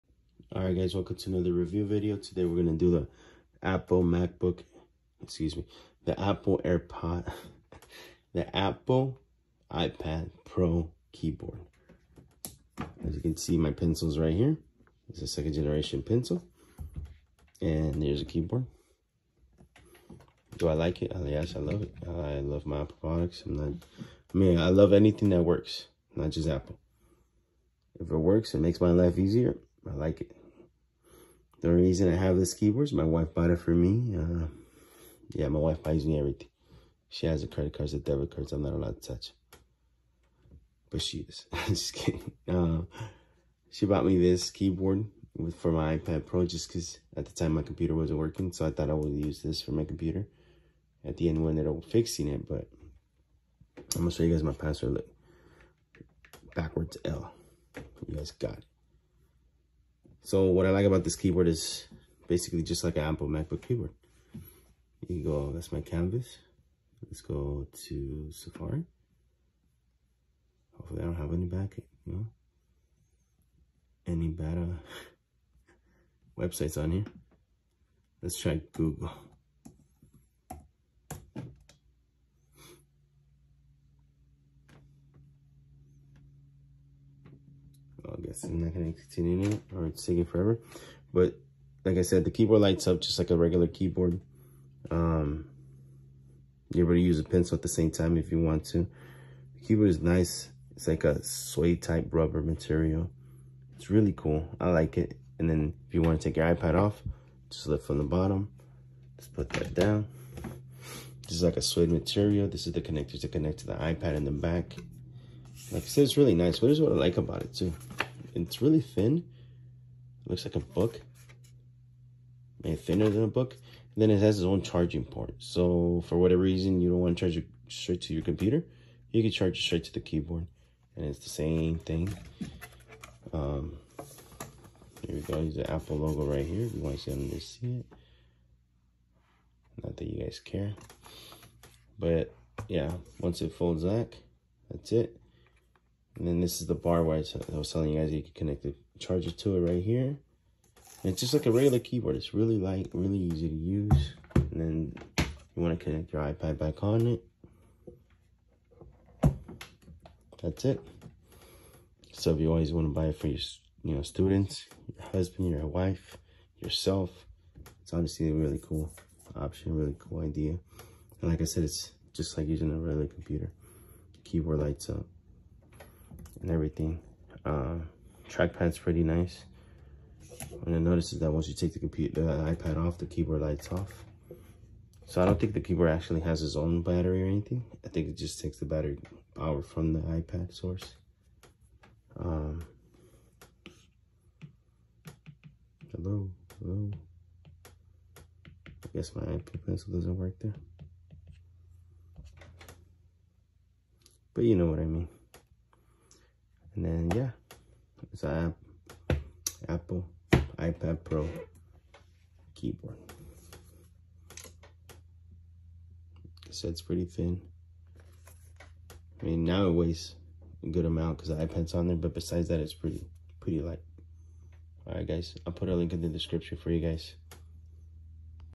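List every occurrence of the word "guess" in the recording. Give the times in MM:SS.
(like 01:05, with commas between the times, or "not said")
01:28, 03:18.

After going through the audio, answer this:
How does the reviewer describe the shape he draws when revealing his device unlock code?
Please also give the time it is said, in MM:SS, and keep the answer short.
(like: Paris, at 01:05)
Backwards L, at 00:56.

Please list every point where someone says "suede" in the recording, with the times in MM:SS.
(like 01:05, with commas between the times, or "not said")
01:41, 01:51.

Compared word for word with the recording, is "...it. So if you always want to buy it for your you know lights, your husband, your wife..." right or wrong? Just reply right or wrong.
wrong.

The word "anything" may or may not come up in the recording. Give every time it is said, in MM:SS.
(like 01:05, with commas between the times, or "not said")
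00:24, 03:07.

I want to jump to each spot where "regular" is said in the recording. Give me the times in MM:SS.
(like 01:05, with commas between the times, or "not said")
01:33, 02:31, 02:52.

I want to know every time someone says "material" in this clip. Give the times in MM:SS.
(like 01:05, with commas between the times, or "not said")
01:42, 01:51.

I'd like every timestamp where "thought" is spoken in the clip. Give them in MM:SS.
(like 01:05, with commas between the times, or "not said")
00:48.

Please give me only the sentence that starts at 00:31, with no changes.
The only reason I have this keyboard is my wife bought it for me.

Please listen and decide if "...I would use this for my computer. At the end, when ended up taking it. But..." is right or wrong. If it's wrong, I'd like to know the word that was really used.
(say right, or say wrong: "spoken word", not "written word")
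wrong: "fixing", not "taking".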